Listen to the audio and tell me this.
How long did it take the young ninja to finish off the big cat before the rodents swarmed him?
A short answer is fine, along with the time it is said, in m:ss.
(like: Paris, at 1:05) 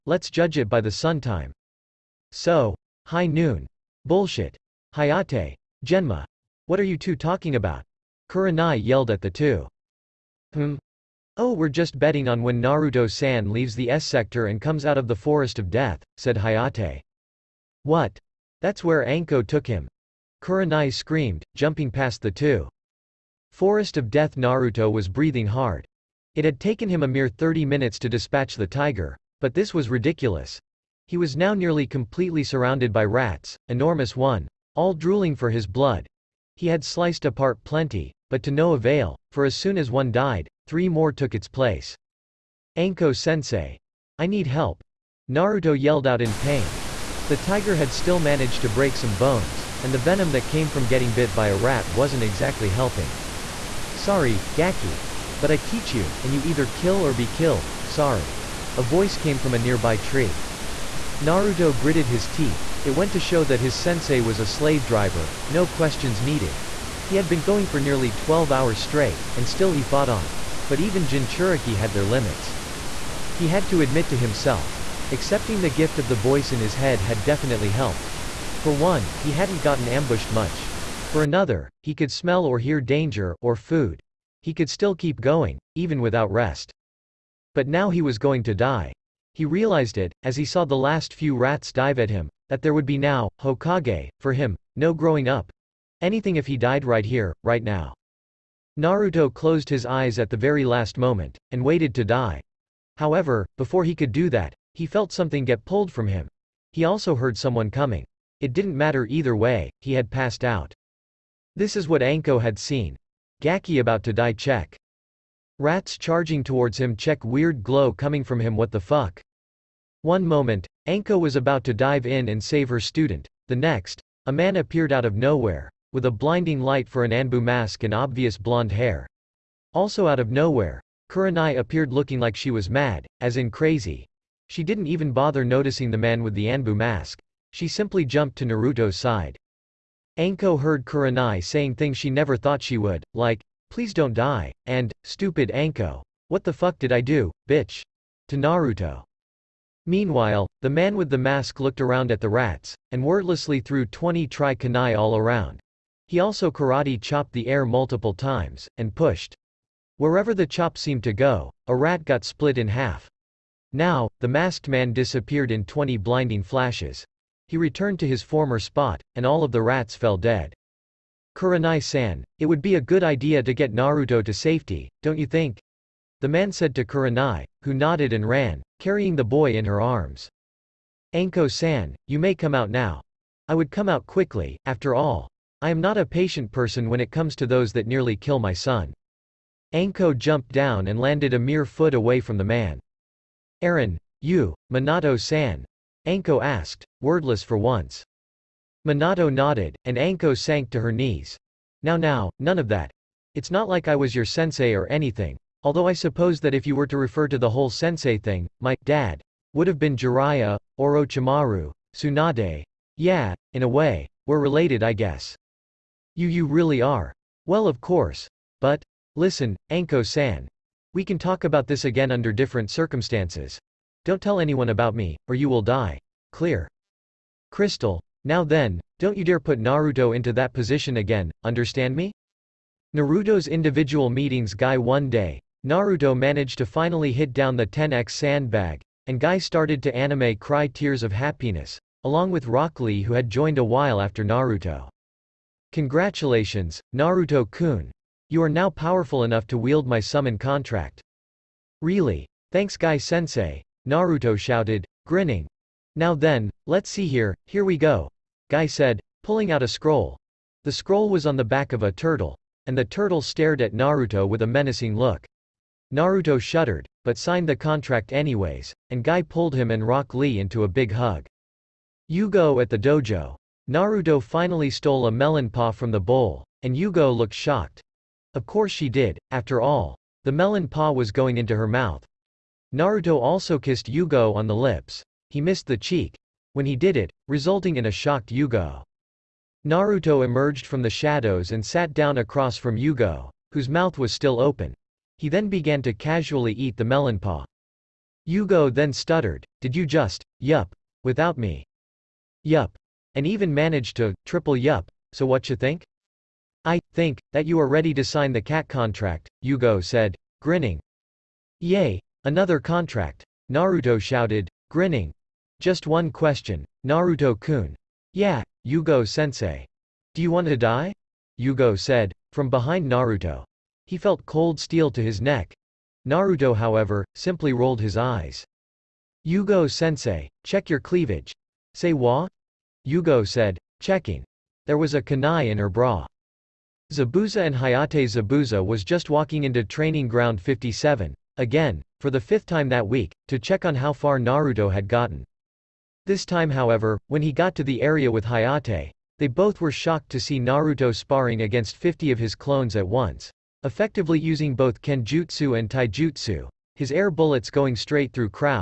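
30 minutes, at 0:27.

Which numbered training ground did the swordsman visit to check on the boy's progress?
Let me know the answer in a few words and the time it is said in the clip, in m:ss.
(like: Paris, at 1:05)
57, at 5:40.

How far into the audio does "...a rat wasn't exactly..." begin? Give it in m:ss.
0:51.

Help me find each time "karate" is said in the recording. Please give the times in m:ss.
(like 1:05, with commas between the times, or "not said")
2:36.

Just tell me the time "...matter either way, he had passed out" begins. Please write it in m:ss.
1:48.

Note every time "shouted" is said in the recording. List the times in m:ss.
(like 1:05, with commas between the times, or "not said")
4:14, 5:13.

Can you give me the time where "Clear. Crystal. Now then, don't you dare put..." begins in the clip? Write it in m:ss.
3:46.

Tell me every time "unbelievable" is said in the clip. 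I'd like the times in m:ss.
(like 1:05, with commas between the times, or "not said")
not said.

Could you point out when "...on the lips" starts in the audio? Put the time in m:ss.
4:44.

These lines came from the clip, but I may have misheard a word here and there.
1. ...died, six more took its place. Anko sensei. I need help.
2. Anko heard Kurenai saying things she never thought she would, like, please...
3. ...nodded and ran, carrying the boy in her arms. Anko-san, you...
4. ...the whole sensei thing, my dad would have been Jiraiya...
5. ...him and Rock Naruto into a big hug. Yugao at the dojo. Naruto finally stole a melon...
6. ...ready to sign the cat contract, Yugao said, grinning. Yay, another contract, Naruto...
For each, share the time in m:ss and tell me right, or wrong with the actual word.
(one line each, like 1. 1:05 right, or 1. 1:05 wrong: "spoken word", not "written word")
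1. 0:40 wrong: "three", not "six"
2. 2:20 right
3. 2:57 right
4. 3:27 right
5. 4:29 wrong: "Lee", not "Naruto"
6. 5:07 right.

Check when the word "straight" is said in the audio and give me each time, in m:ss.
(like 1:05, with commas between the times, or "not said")
1:08, 5:57.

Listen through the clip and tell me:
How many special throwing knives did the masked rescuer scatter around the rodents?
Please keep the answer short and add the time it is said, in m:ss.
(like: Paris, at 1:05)
20, at 2:33.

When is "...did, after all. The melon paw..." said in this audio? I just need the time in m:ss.
4:38.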